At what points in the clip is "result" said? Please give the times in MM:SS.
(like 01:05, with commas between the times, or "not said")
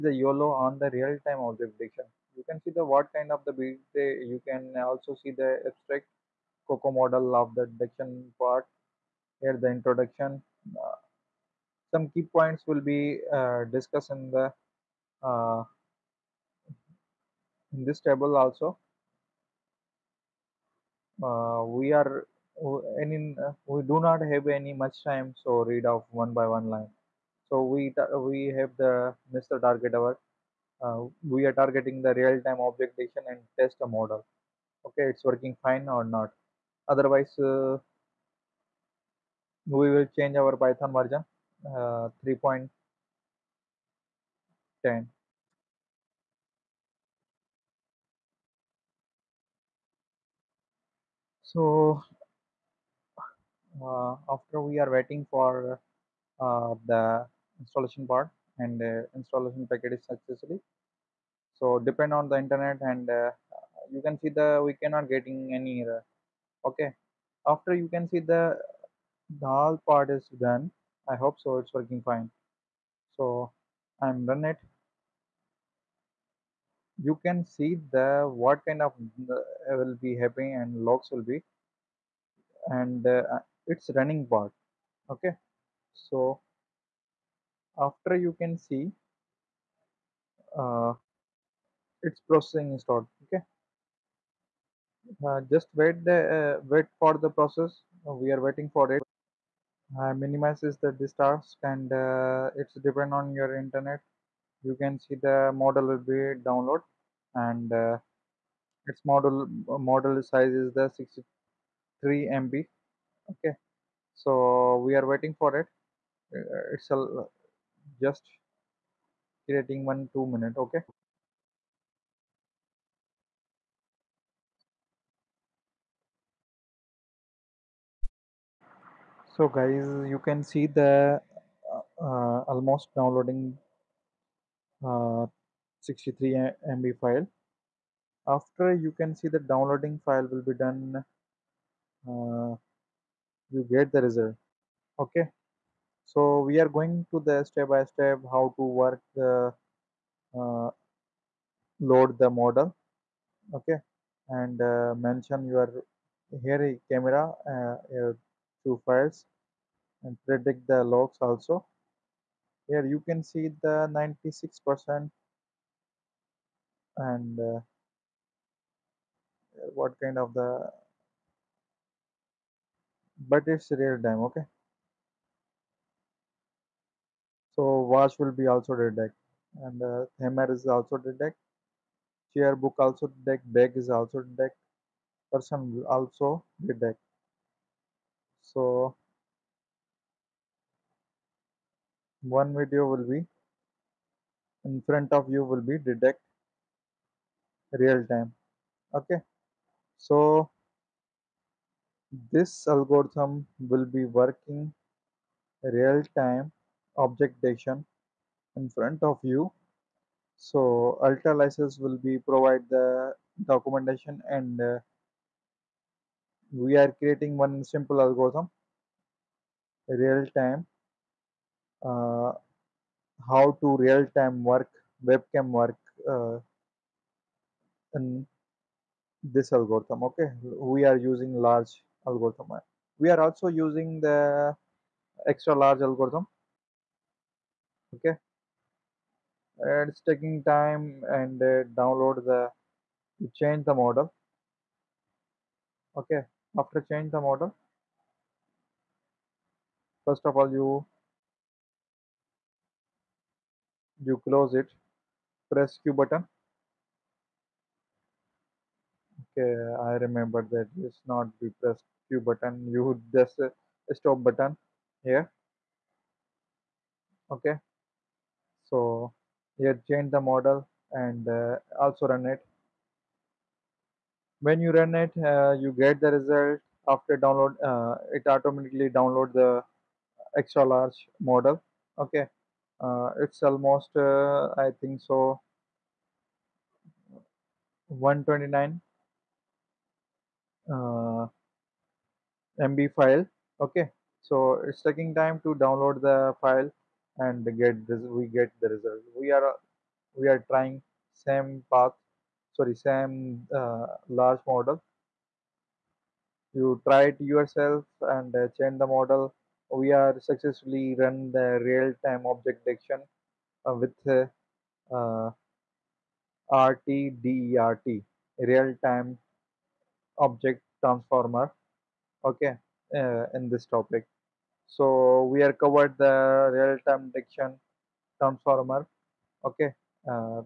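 02:24, 04:36, 04:58.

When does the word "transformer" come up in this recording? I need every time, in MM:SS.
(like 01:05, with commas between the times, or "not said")
05:20, 05:28.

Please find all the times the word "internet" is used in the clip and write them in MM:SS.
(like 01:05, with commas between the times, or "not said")
01:02, 01:43.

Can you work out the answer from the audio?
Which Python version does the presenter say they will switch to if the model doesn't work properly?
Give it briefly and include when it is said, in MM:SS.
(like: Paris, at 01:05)
3.10, at 00:42.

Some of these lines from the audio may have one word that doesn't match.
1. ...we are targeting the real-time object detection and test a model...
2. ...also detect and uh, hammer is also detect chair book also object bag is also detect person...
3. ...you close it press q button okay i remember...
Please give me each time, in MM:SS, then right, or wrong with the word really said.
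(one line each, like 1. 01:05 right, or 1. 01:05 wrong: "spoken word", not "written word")
1. 00:31 right
2. 02:58 wrong: "detect", not "object"
3. 04:14 right.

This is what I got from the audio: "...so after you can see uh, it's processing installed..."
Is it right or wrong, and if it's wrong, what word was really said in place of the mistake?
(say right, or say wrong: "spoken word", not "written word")
right.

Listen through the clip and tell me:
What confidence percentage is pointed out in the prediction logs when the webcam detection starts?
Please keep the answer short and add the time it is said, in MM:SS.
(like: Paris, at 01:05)
96 percent, at 02:43.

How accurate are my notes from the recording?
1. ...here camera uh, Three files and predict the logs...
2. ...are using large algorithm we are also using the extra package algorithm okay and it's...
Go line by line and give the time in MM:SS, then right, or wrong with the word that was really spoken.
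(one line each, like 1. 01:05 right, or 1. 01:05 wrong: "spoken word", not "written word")
1. 02:36 wrong: "Two", not "Three"
2. 03:50 wrong: "large", not "package".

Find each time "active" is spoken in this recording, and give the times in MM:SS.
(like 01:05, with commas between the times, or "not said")
not said.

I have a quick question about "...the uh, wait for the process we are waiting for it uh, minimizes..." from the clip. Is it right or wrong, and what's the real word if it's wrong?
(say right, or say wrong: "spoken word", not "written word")
right.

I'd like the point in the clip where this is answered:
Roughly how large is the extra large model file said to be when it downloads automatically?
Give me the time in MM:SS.
04:48.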